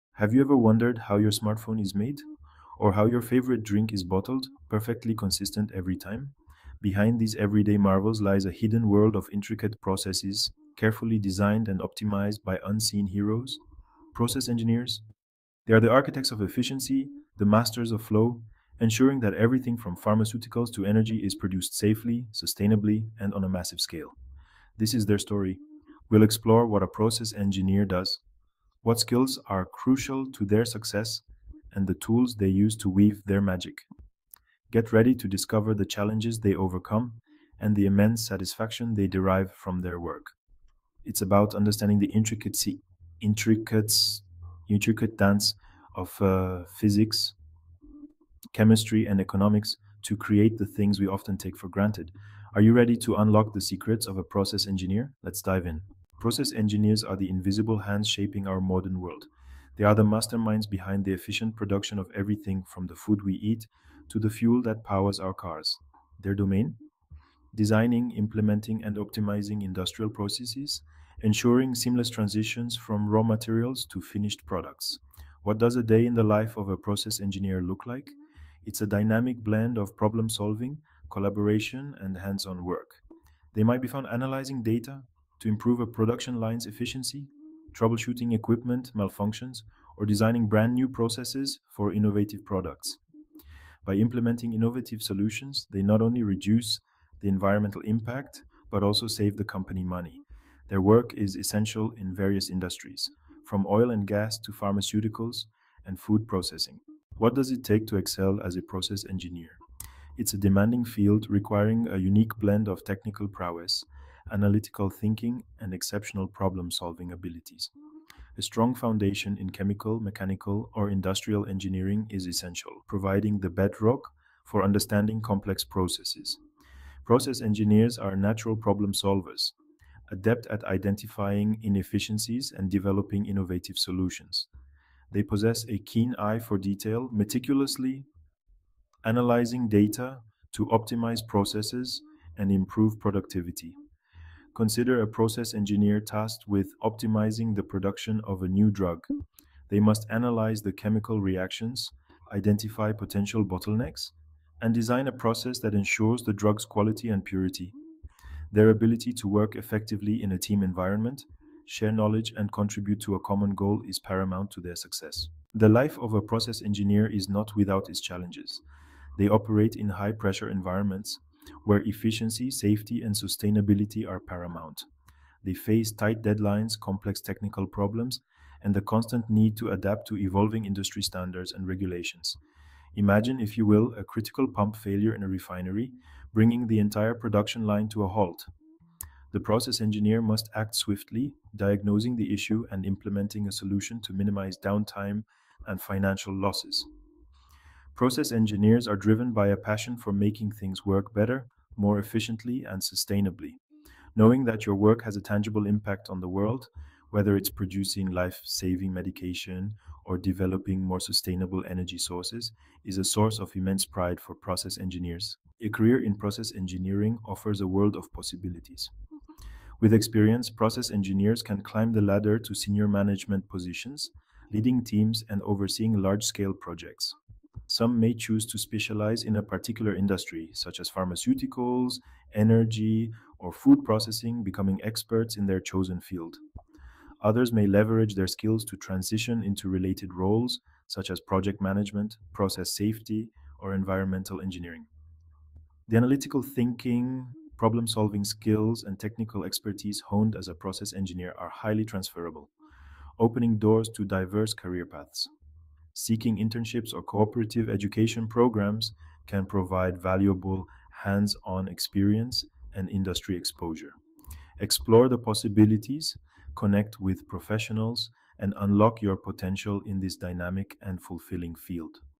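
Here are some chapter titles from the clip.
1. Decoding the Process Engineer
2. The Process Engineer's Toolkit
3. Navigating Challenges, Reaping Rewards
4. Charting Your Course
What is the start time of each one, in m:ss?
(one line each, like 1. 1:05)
1. 0:56
2. 1:46
3. 2:45
4. 3:35.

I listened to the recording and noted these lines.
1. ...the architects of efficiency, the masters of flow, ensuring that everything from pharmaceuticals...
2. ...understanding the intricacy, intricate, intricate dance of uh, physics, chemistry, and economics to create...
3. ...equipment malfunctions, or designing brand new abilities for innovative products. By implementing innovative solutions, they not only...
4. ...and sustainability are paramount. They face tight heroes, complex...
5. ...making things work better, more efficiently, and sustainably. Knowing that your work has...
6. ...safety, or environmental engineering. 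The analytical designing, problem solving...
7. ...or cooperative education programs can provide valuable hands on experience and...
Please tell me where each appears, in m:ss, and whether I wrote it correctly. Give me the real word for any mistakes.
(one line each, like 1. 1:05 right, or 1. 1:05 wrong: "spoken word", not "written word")
1. 0:15 right
2. 0:41 right
3. 1:28 wrong: "processes", not "abilities"
4. 2:53 wrong: "deadlines", not "heroes"
5. 3:20 right
6. 4:02 wrong: "thinking", not "designing"
7. 4:16 right.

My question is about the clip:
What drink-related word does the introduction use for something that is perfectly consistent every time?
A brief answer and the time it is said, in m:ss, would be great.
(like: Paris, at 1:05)
Bottled, at 0:04.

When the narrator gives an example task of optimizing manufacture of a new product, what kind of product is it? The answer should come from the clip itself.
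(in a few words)
A new drug.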